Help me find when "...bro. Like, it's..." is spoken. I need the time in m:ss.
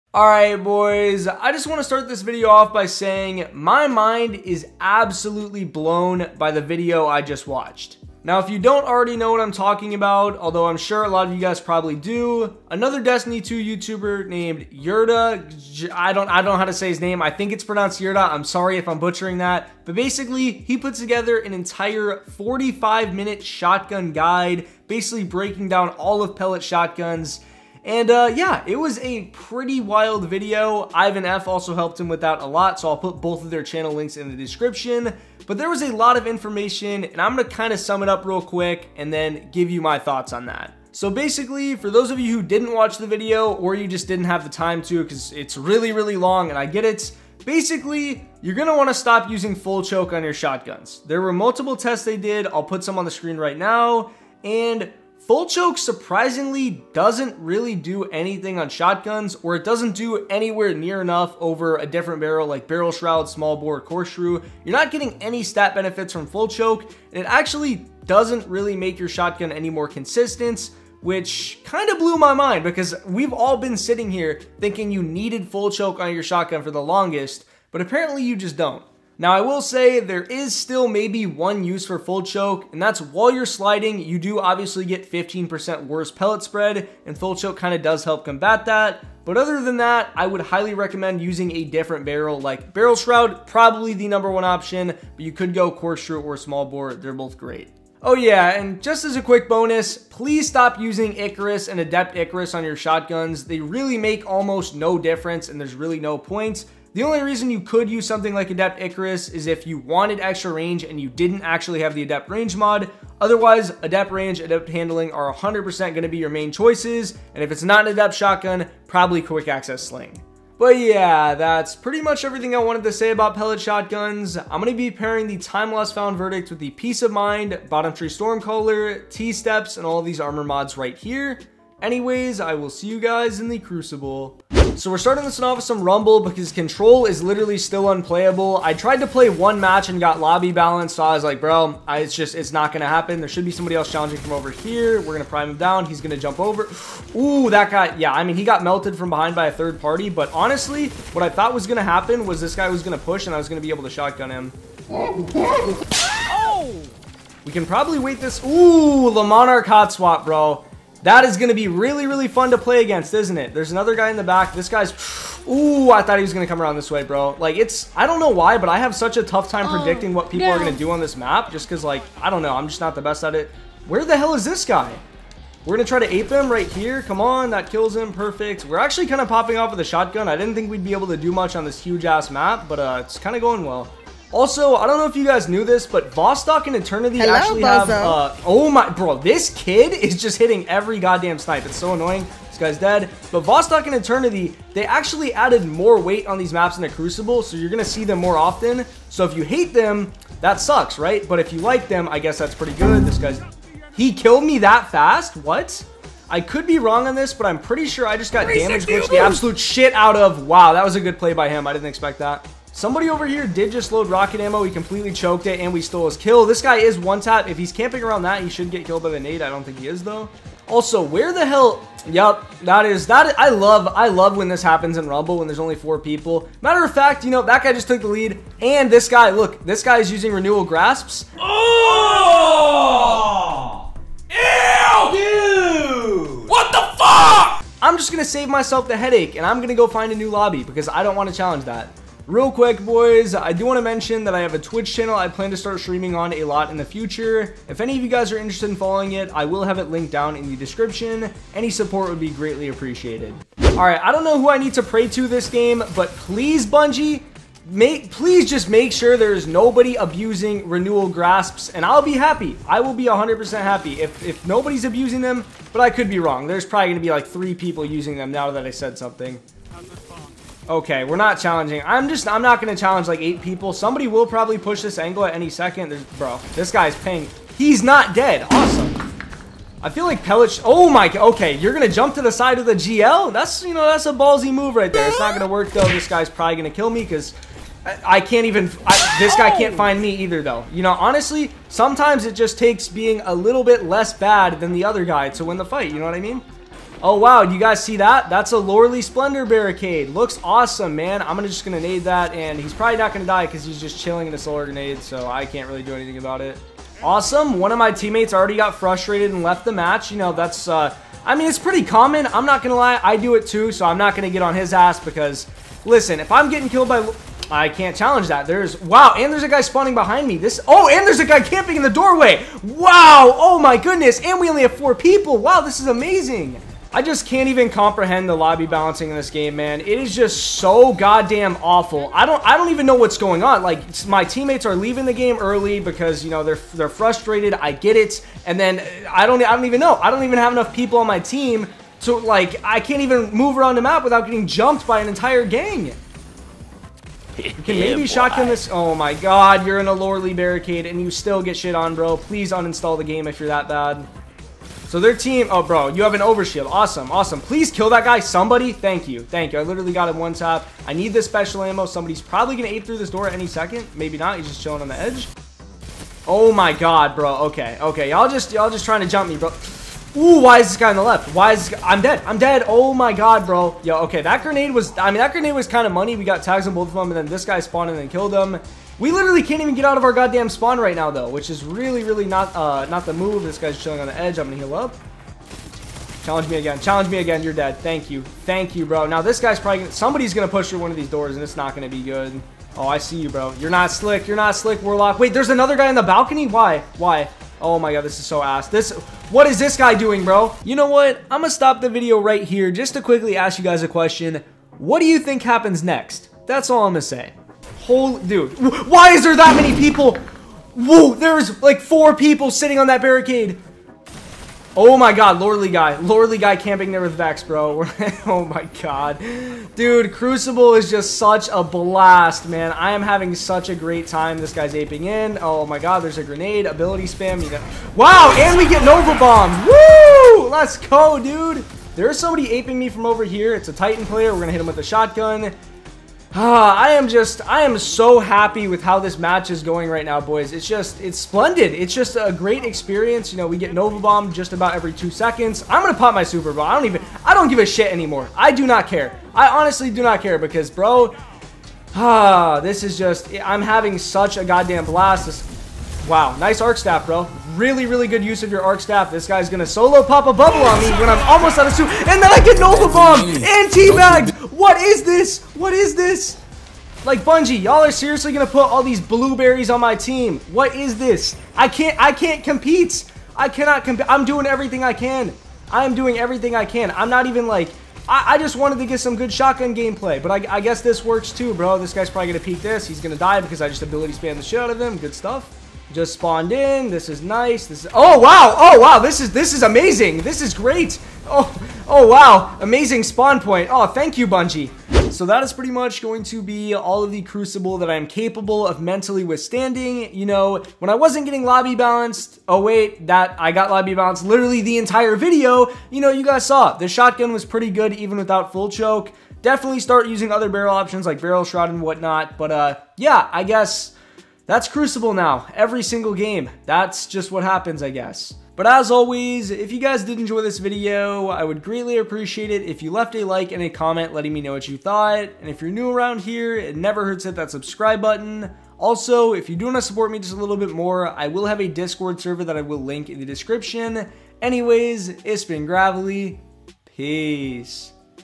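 2:47.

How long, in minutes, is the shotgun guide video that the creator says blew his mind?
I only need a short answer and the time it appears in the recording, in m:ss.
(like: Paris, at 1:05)
45, at 0:22.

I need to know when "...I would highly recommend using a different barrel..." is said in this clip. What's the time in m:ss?
1:30.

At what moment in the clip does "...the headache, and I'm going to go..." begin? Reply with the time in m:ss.
3:58.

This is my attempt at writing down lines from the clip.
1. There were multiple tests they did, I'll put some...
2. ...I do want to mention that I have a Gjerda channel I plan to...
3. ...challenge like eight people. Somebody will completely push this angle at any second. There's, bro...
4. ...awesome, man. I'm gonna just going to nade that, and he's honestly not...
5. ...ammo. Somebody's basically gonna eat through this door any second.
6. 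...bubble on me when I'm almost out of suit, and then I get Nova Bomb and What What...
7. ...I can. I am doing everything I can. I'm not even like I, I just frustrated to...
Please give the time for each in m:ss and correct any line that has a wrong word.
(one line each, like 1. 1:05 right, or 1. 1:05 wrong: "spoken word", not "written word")
1. 0:51 right
2. 4:03 wrong: "Twitch", not "Gjerda"
3. 4:32 wrong: "probably", not "completely"
4. 5:00 wrong: "probably", not "honestly"
5. 6:01 wrong: "probably", not "basically"
6. 7:40 right
7. 7:54 wrong: "wanted", not "frustrated".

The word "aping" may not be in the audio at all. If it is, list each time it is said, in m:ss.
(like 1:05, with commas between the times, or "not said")
7:04, 7:12.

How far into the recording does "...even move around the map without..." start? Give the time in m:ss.
5:43.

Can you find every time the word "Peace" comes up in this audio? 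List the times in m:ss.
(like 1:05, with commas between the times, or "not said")
2:06, 8:56.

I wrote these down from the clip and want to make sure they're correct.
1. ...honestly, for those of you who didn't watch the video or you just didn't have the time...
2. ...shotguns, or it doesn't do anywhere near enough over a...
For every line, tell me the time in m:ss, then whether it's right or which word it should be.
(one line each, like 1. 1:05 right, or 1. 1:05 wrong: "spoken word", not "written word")
1. 0:41 wrong: "basically", not "honestly"
2. 0:58 right.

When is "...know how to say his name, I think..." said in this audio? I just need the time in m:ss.
0:16.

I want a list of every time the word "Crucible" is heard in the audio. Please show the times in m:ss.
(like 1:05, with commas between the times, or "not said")
2:13, 3:16, 7:00, 8:17, 8:34.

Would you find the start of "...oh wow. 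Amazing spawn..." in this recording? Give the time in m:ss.
8:11.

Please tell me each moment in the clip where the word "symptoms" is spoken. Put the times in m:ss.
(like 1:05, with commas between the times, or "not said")
not said.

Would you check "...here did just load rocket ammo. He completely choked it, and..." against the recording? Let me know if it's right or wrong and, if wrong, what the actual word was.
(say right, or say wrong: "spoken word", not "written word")
right.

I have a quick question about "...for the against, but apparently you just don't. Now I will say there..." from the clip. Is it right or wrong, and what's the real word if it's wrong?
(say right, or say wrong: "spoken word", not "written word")
wrong: "longest", not "against".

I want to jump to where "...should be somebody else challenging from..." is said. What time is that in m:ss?
2:23.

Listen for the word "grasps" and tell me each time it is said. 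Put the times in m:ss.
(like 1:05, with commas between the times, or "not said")
3:50, 4:21.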